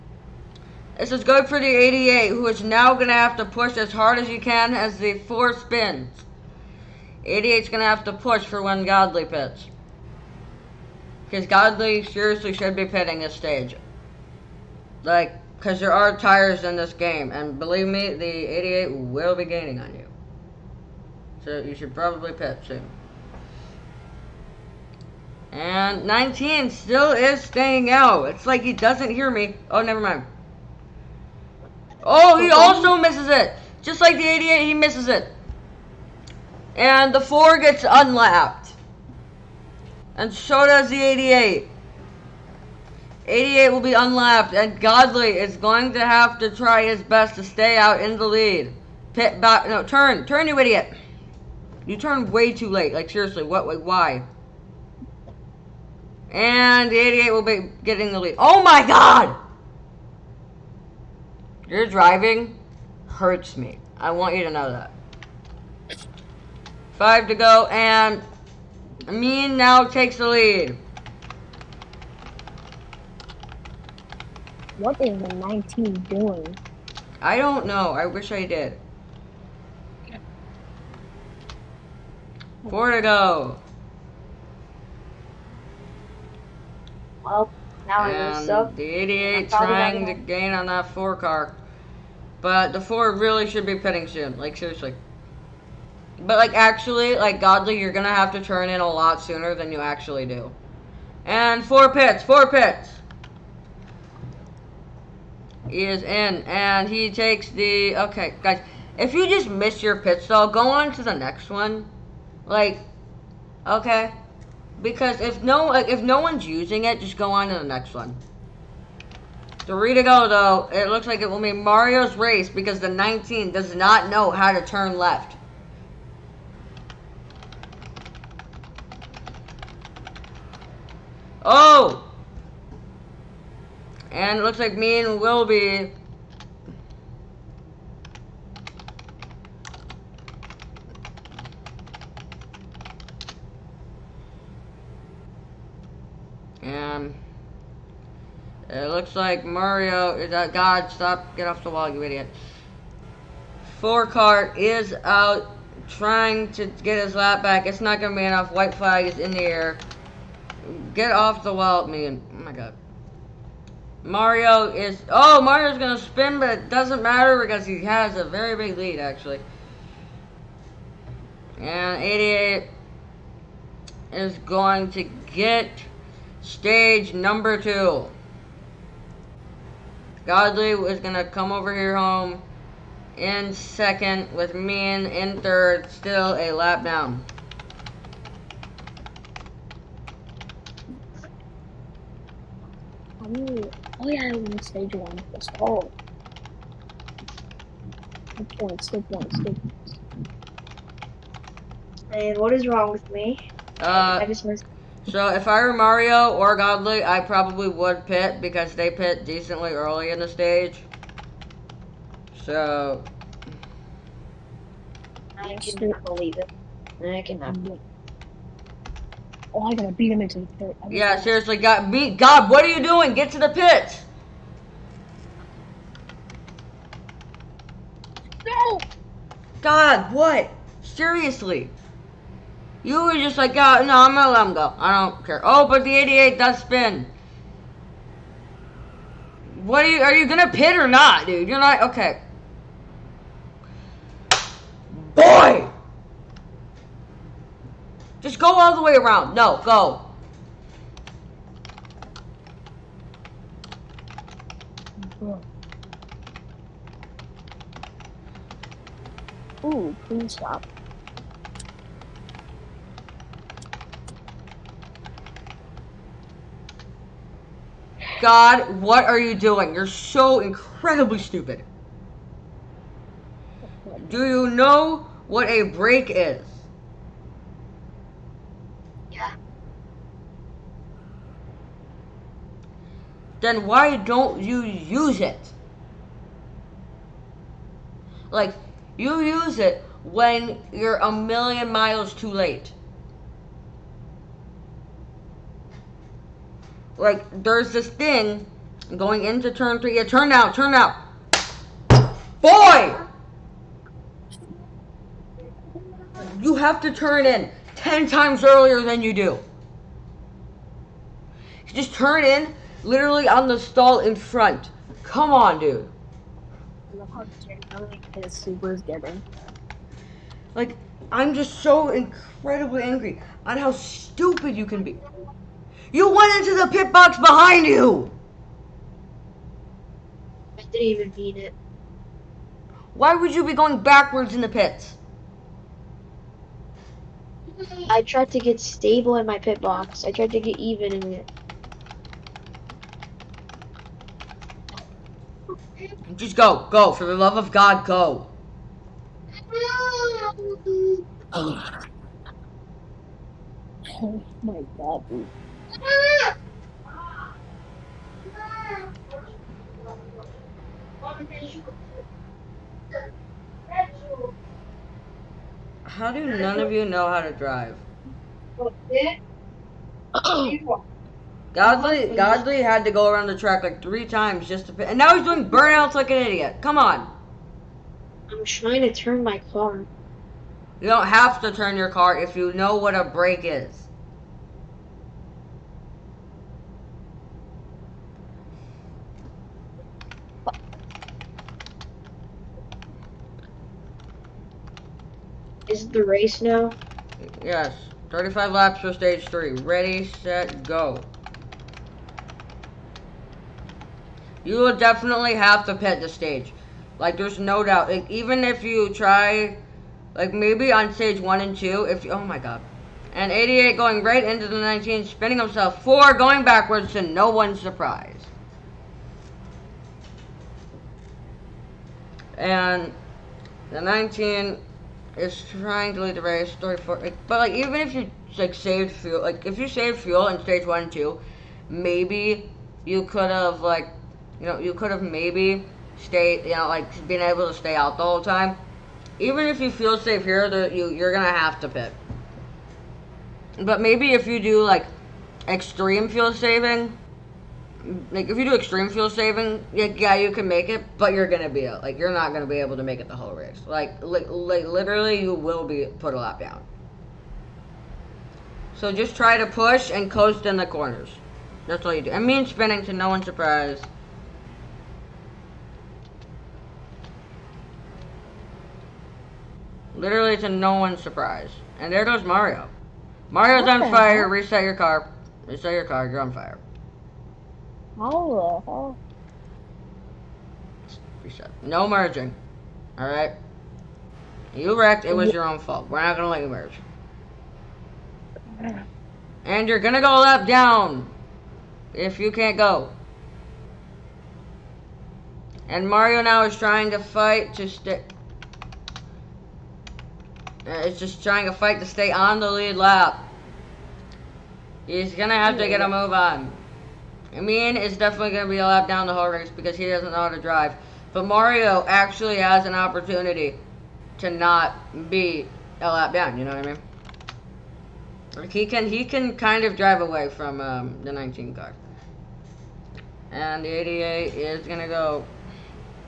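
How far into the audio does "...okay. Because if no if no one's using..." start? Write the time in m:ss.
1:53.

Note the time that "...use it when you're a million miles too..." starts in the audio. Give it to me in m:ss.
4:49.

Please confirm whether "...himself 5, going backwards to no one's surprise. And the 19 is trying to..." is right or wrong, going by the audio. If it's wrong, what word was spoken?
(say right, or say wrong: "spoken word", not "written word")
wrong: "4", not "5".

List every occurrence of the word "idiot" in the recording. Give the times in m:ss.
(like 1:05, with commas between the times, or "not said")
0:50, 2:32, 6:16.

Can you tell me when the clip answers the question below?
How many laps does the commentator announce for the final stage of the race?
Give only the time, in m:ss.
6:38.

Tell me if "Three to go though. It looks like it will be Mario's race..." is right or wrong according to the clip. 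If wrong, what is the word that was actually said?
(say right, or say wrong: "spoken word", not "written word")
right.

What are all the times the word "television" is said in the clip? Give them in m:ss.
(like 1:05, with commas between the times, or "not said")
not said.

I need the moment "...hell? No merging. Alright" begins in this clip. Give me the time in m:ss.
8:01.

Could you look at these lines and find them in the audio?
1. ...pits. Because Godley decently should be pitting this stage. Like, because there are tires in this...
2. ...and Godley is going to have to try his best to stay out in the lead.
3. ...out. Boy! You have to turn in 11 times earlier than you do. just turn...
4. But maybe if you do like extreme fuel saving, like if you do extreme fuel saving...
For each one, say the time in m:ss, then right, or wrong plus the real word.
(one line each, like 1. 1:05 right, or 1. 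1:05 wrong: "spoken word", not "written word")
1. 0:09 wrong: "seriously", not "decently"
2. 0:44 right
3. 5:00 wrong: "10", not "11"
4. 7:23 right.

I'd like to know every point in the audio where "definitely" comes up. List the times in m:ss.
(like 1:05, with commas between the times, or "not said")
6:44, 8:27.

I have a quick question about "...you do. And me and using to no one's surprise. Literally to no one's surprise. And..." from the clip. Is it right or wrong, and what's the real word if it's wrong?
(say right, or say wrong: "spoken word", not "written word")
wrong: "spinning", not "using".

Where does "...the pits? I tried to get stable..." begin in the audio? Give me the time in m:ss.
5:34.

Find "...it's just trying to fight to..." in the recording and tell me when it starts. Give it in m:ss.
8:20.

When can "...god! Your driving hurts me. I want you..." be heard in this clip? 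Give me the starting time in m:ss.
0:58.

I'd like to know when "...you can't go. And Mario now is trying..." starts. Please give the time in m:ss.
8:12.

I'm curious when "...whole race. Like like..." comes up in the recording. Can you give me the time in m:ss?
7:33.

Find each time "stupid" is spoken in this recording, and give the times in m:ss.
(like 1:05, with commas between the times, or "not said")
4:31, 5:23.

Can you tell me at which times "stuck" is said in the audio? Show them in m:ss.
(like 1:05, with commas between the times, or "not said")
1:28.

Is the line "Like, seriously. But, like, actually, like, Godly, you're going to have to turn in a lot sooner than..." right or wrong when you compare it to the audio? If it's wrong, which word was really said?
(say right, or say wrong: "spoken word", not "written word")
right.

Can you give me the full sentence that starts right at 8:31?
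But Mario actually has an opportunity to not be a lap down.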